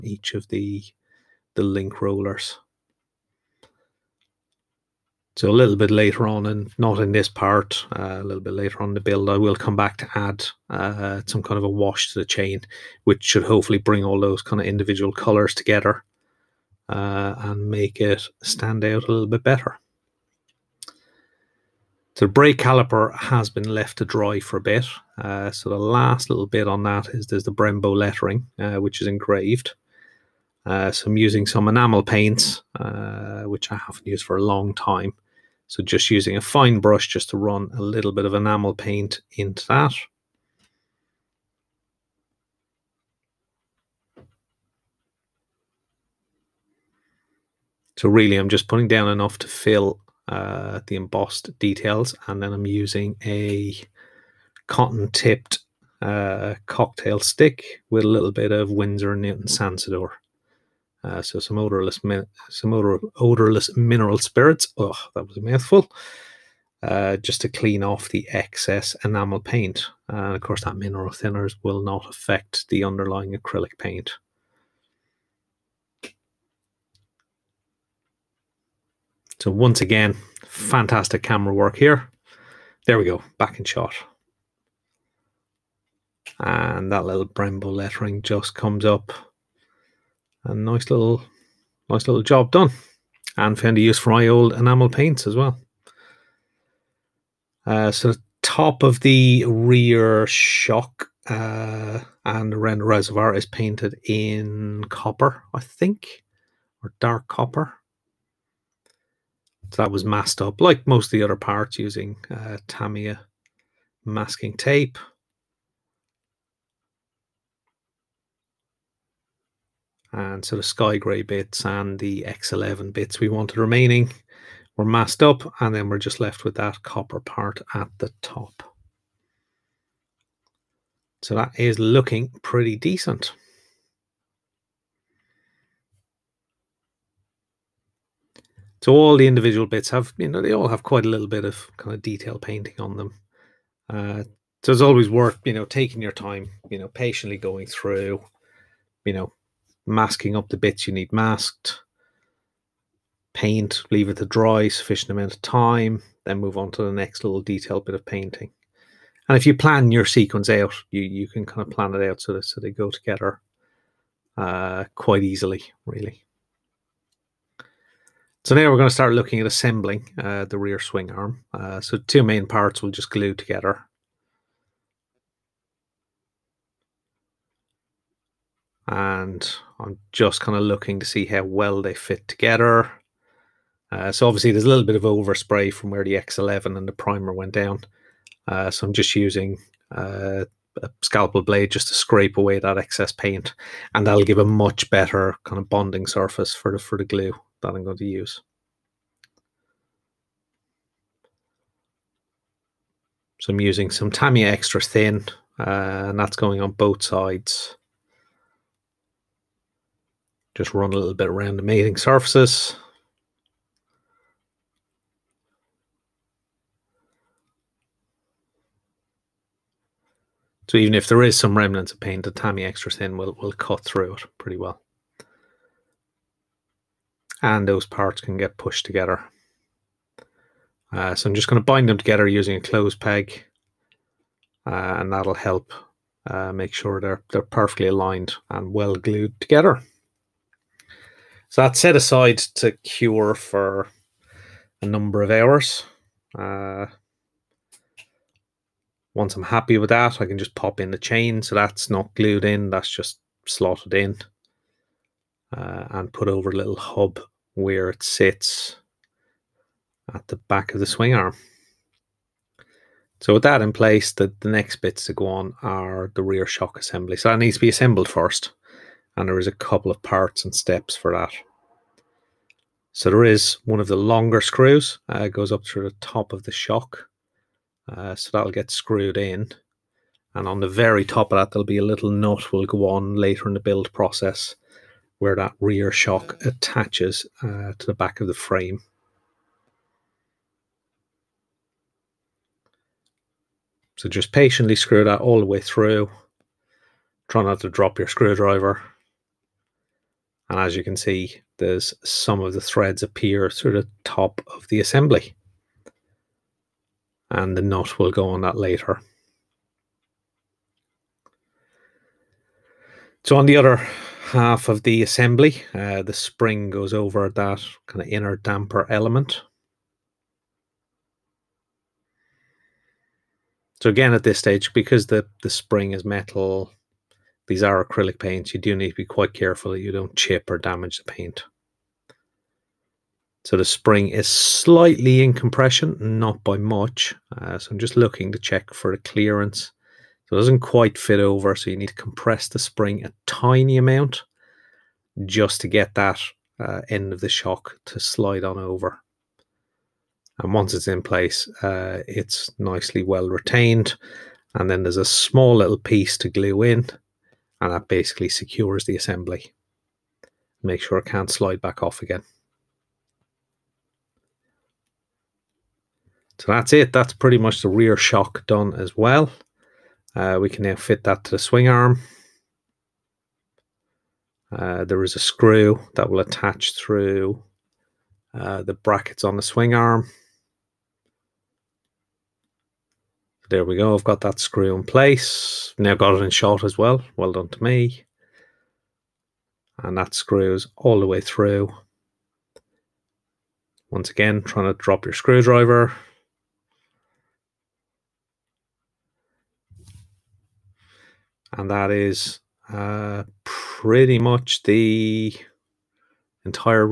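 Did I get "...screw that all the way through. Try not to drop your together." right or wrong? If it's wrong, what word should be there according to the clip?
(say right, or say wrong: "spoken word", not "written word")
wrong: "screwdriver", not "together".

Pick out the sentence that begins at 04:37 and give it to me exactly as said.
Uh, so that'll get screwed in.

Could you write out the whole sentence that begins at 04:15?
Uh, and put over a little hub where it sits at the back of the swing arm.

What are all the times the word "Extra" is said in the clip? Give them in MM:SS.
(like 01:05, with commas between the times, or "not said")
03:24, 03:42.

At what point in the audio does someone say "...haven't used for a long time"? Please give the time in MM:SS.
00:33.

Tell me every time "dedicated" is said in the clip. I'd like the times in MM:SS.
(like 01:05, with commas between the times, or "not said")
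not said.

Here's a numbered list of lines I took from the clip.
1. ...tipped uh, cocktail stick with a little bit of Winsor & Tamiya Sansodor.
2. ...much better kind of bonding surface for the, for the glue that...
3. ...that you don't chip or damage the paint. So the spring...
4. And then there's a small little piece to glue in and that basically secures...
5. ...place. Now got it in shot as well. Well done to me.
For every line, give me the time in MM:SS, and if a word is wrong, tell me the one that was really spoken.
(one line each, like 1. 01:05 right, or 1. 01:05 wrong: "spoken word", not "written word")
1. 00:55 wrong: "Newton", not "Tamiya"
2. 03:14 right
3. 05:29 right
4. 05:54 right
5. 06:24 right.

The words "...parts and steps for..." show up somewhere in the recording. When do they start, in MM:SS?
04:30.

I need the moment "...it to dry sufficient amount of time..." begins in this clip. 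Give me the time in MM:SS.
02:34.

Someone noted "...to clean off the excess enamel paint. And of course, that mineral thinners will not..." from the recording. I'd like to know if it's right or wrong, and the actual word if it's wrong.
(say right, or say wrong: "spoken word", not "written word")
right.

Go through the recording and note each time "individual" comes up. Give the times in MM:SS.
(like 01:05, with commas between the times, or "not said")
00:14, 02:19.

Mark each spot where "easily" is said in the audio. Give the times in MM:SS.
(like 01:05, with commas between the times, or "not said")
02:45.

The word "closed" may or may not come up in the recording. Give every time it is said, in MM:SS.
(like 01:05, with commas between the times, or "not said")
03:52.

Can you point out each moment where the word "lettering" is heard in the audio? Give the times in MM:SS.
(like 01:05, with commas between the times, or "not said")
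00:27, 01:27.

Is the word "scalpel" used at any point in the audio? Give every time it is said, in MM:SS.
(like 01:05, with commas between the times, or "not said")
03:11.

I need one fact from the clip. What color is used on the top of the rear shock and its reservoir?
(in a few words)
Dark copper.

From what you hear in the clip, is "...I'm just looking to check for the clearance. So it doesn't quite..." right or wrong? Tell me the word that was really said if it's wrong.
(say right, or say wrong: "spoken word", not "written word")
right.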